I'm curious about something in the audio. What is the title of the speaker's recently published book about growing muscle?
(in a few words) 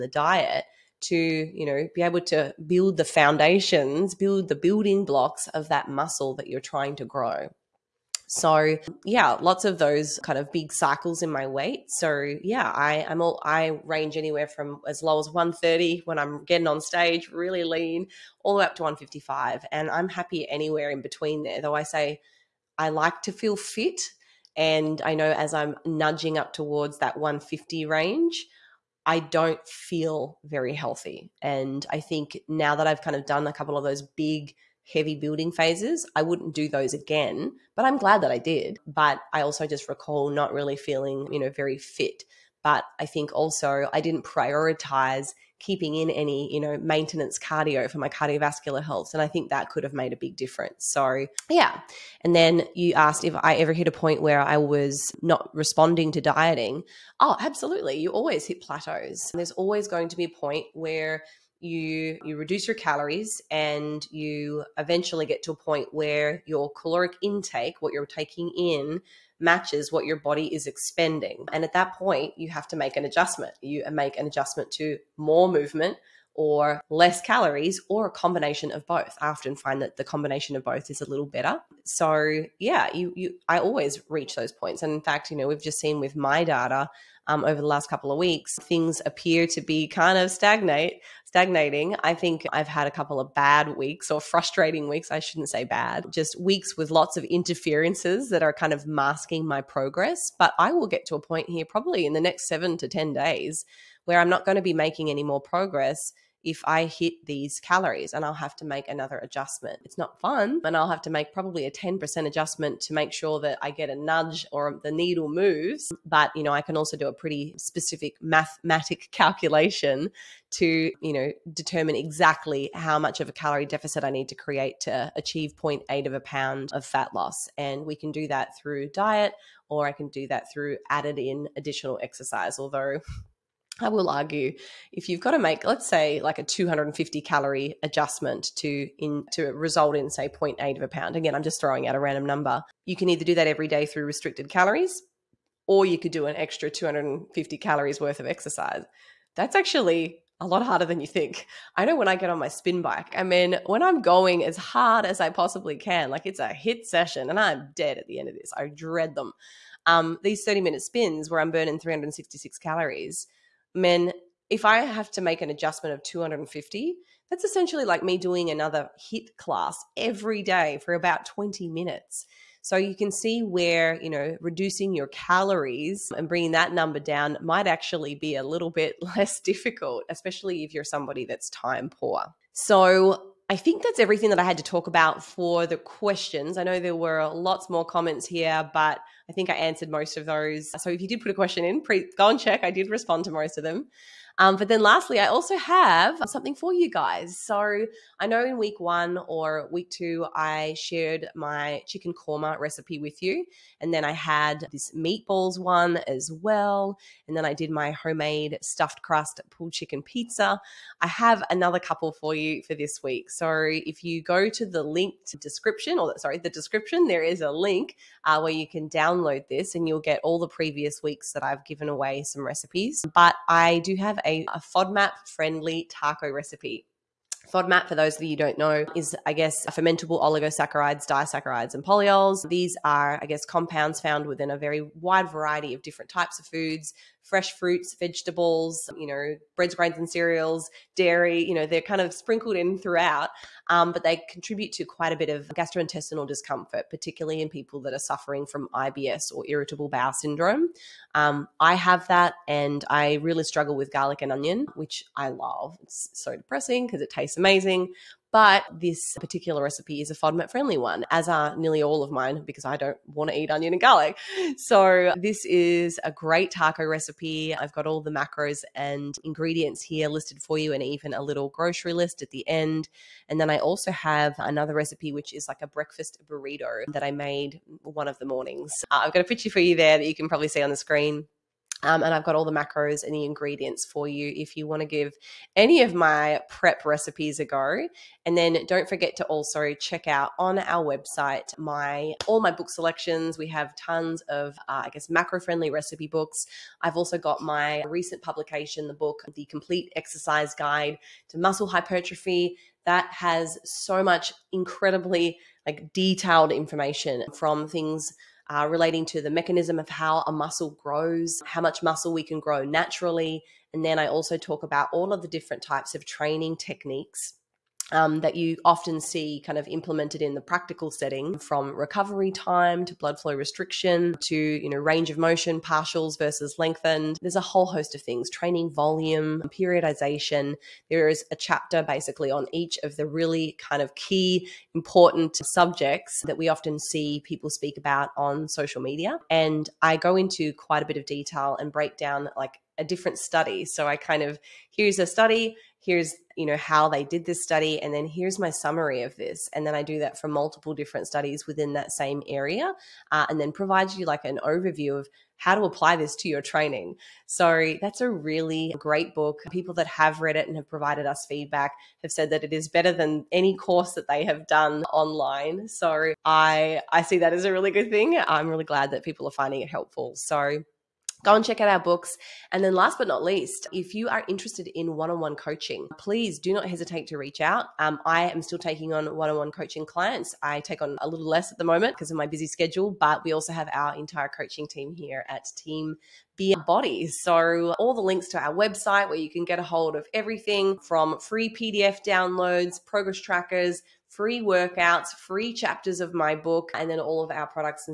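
The Complete Exercise Guide to Muscle Hypertrophy.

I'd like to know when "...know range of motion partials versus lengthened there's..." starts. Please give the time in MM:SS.
05:24.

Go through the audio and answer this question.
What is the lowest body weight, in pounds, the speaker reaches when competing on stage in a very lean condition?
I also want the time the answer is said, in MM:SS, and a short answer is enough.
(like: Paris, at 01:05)
130, at 00:15.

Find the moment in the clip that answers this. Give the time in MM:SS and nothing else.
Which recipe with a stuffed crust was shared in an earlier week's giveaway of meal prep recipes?
03:28.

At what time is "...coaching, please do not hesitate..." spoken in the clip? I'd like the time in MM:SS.
06:15.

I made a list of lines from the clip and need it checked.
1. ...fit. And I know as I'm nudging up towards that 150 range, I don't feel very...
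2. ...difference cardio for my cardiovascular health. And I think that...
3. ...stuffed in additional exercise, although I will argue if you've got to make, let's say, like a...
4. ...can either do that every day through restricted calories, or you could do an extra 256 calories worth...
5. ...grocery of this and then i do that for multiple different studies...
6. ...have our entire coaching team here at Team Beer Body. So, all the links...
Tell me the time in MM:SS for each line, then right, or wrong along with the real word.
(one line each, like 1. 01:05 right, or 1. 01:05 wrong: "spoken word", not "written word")
1. 00:23 right
2. 00:46 wrong: "maintenance", not "difference"
3. 02:10 wrong: "added", not "stuffed"
4. 02:22 wrong: "250", not "256"
5. 05:48 wrong: "summary", not "grocery"
6. 06:23 right.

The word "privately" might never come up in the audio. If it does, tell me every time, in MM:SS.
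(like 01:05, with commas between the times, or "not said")
not said.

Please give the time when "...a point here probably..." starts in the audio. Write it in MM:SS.
01:41.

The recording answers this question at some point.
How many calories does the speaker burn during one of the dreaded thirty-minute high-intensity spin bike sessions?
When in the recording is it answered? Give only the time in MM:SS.
02:41.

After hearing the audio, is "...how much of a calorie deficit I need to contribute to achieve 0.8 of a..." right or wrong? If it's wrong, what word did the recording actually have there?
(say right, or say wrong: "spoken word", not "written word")
wrong: "create", not "contribute".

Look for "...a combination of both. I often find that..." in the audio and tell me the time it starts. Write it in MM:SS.
01:18.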